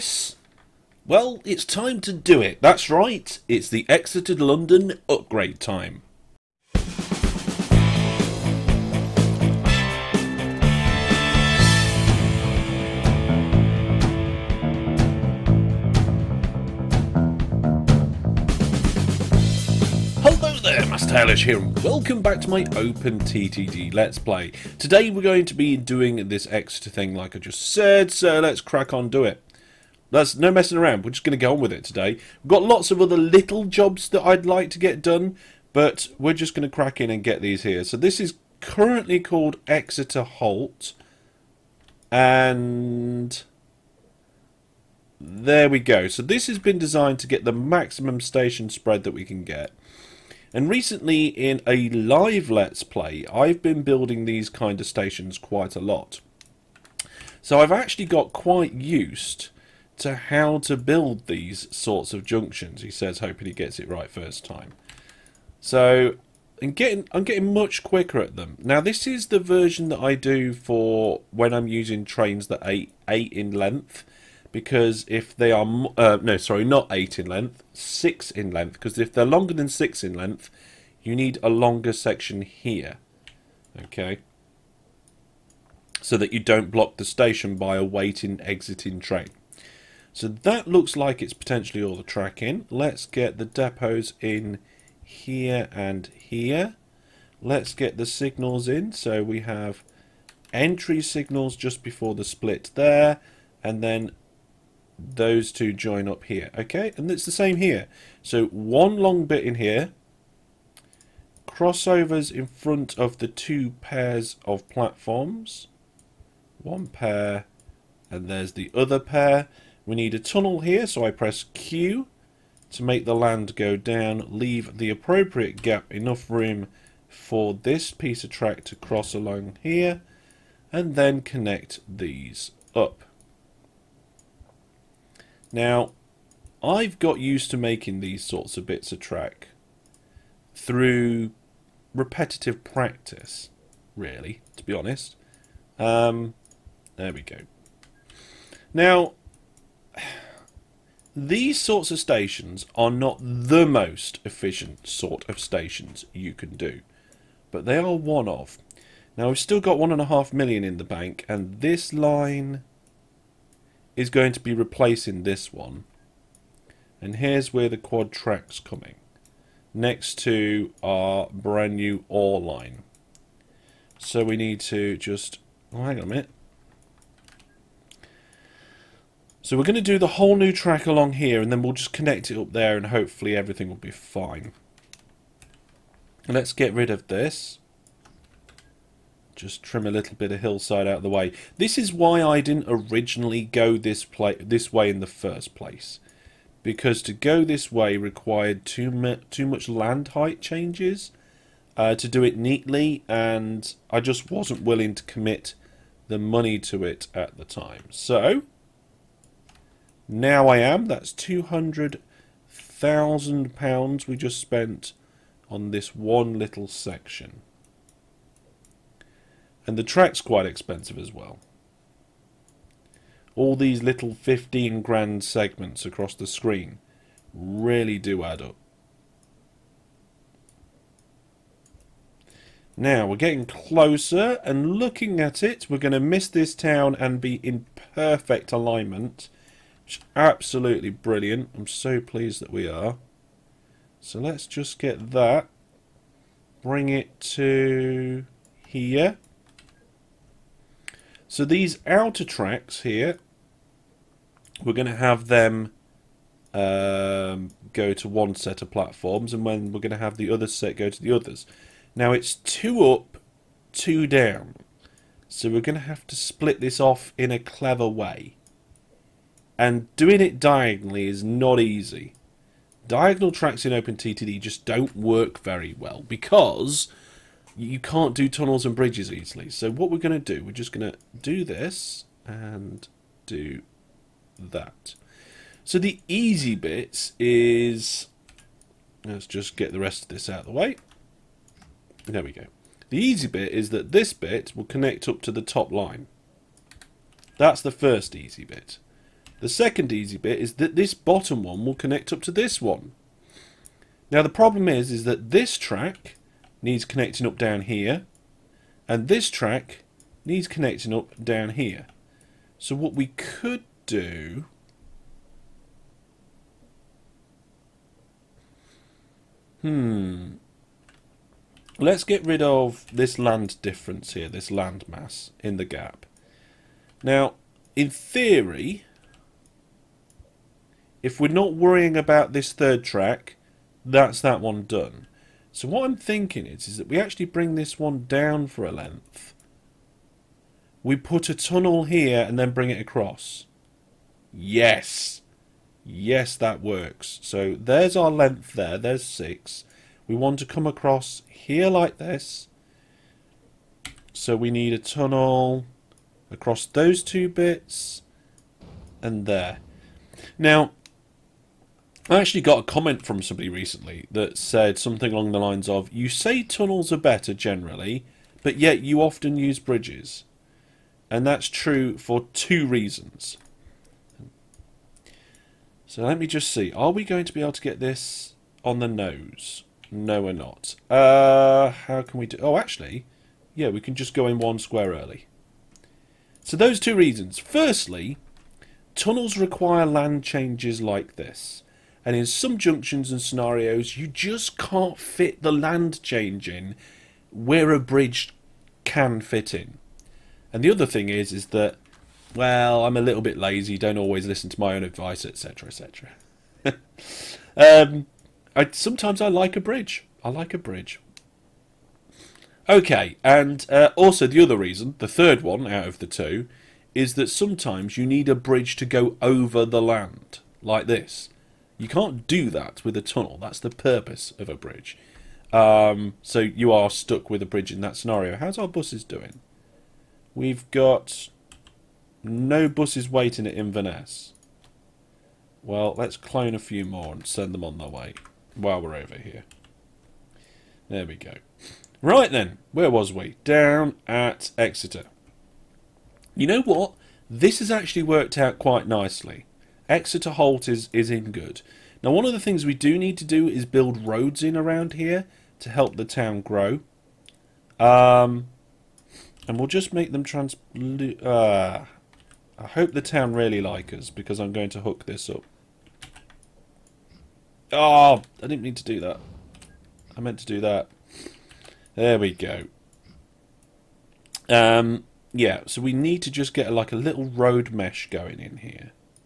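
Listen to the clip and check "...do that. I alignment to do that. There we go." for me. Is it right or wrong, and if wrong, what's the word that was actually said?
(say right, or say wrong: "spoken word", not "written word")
wrong: "meant", not "alignment".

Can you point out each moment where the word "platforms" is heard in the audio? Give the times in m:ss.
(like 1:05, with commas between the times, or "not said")
1:54, 4:18.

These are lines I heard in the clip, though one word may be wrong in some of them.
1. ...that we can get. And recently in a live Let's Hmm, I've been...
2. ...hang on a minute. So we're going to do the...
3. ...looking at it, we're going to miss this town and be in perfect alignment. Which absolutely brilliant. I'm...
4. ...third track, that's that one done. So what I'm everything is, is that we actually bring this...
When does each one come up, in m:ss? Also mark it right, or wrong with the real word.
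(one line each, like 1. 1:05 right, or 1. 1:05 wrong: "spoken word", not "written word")
1. 0:49 wrong: "Play", not "Hmm"
2. 2:55 right
3. 3:54 right
4. 5:32 wrong: "thinking", not "everything".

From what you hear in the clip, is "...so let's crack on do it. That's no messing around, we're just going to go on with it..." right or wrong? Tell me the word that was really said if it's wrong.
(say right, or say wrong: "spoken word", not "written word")
right.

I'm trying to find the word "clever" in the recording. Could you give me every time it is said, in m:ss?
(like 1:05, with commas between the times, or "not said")
4:27.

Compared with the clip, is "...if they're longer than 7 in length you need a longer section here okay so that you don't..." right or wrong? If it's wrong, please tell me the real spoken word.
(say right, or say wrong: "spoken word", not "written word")
wrong: "6", not "7".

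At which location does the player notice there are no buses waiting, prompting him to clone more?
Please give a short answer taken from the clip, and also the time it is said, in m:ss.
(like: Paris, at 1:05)
Inverness, at 7:13.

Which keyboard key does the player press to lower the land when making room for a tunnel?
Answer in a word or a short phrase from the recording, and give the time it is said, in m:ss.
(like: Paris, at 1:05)
Q, at 2:01.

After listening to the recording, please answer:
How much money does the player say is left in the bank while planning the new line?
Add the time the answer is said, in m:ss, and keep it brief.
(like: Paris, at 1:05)
1.5 million, at 2:39.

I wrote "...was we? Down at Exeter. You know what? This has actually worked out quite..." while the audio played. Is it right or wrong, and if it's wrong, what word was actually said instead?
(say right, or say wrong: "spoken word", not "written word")
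right.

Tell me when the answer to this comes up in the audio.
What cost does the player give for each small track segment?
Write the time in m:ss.
3:44.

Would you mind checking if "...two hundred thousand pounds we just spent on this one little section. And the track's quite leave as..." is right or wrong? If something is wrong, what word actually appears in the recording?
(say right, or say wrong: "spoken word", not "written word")
wrong: "expensive", not "leave".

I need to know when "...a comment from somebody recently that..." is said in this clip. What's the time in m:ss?
6:02.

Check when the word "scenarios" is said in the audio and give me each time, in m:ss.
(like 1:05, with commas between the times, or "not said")
6:33, 7:07.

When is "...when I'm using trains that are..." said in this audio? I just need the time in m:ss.
1:11.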